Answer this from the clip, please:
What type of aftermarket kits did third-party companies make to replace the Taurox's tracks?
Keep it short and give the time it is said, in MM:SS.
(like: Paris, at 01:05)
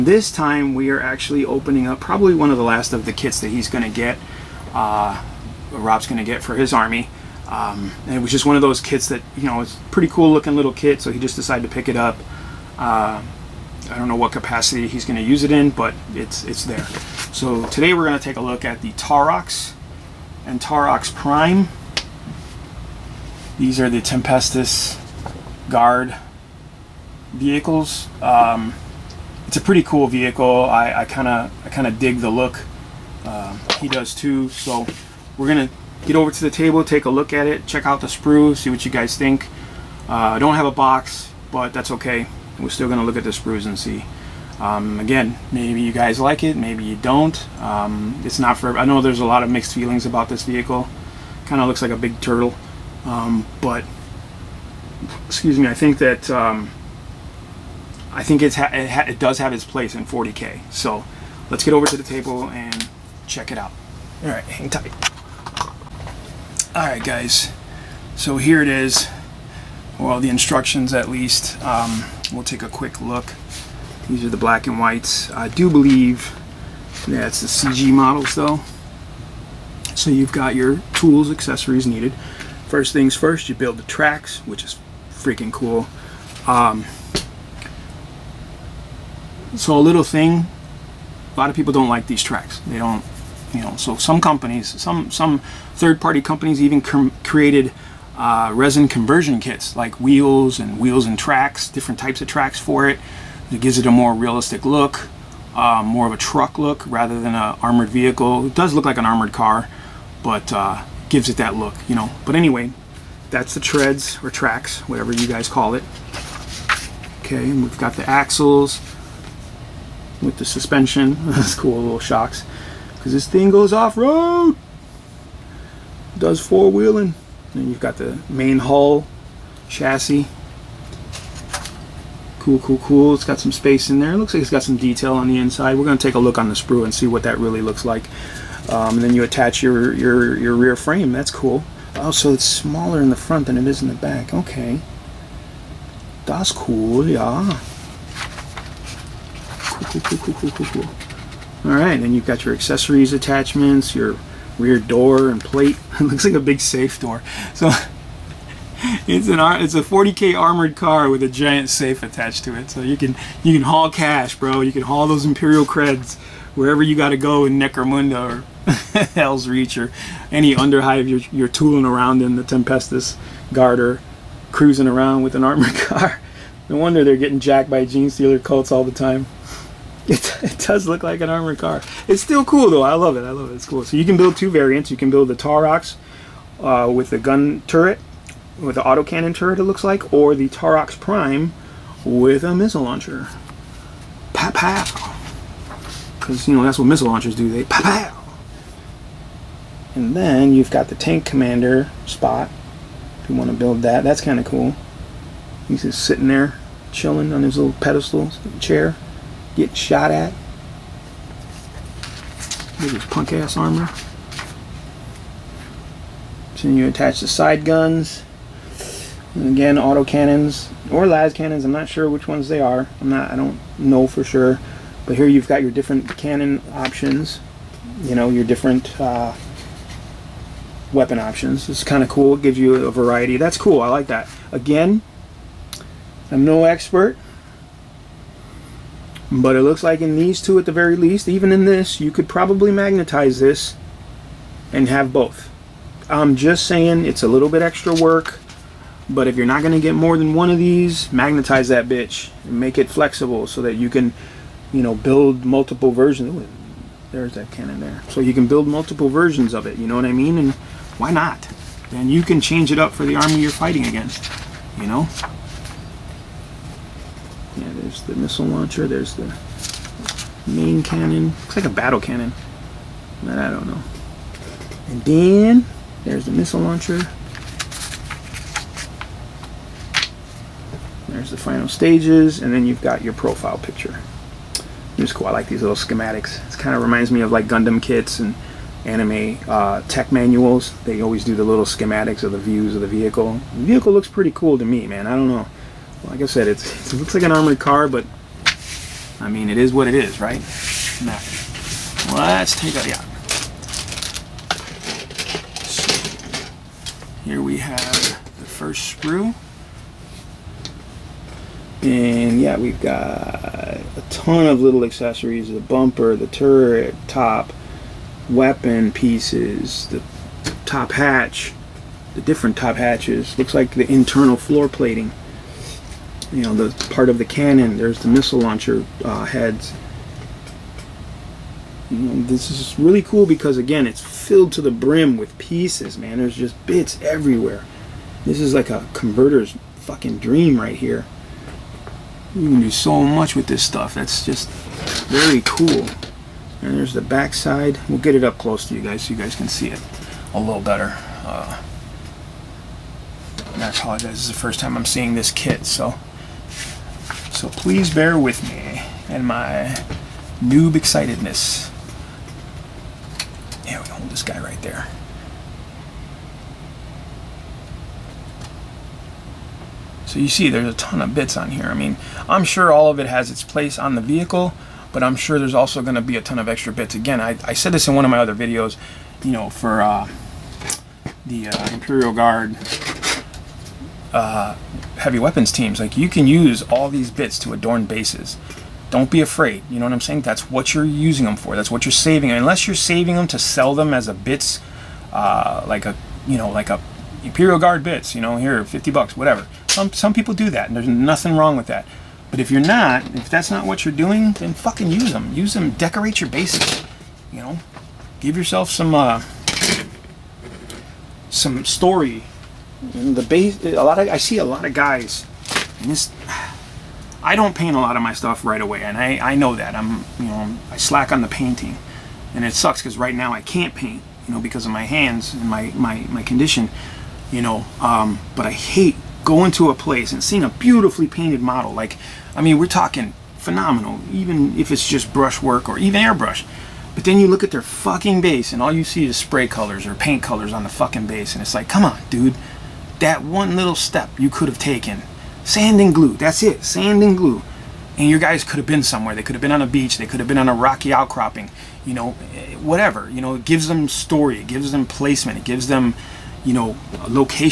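resin conversion kits, at 01:38.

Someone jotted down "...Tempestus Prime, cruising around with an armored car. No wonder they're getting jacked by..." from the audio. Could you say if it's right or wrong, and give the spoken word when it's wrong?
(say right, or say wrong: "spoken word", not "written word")
wrong: "Garter", not "Prime".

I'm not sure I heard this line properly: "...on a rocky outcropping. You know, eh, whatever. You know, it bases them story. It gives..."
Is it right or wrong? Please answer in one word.
wrong.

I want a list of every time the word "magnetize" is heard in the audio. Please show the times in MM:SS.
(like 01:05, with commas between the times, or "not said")
04:02, 04:11.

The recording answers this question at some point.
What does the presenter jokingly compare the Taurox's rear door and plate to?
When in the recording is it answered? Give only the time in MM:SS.
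02:36.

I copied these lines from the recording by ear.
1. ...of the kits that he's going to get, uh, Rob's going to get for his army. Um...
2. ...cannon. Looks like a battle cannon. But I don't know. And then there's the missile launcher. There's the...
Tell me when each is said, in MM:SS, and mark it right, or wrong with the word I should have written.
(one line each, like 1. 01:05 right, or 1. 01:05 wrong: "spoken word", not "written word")
1. 00:02 right
2. 04:30 right.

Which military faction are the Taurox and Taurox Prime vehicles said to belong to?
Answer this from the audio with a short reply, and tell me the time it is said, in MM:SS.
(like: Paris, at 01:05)
Tempestus Guard, at 00:23.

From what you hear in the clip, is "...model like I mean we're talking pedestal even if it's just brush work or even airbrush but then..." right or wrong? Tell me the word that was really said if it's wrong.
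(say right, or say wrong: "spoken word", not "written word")
wrong: "phenomenal", not "pedestal".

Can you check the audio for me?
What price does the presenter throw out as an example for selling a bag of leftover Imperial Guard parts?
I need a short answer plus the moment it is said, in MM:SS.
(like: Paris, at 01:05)
50 bucks, at 06:38.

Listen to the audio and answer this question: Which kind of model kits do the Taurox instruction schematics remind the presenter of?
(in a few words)
Gundam kits.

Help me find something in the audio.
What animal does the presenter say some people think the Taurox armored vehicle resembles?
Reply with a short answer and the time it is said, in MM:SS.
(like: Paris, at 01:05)
a big turtle, at 00:51.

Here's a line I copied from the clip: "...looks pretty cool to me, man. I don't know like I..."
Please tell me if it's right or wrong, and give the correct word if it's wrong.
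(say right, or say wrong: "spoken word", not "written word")
right.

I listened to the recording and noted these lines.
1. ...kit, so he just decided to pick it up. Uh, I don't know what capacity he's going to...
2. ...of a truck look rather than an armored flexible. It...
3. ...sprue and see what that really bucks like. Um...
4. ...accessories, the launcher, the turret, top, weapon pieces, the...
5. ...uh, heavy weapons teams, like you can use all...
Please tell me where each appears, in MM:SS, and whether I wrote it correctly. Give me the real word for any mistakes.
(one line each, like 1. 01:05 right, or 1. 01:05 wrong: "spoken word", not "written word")
1. 00:10 right
2. 01:46 wrong: "vehicle", not "flexible"
3. 02:16 wrong: "looks", not "bucks"
4. 05:14 wrong: "bumper", not "launcher"
5. 06:24 right.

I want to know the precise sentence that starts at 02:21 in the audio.
Oh, so it's smaller in the front than it is in the back.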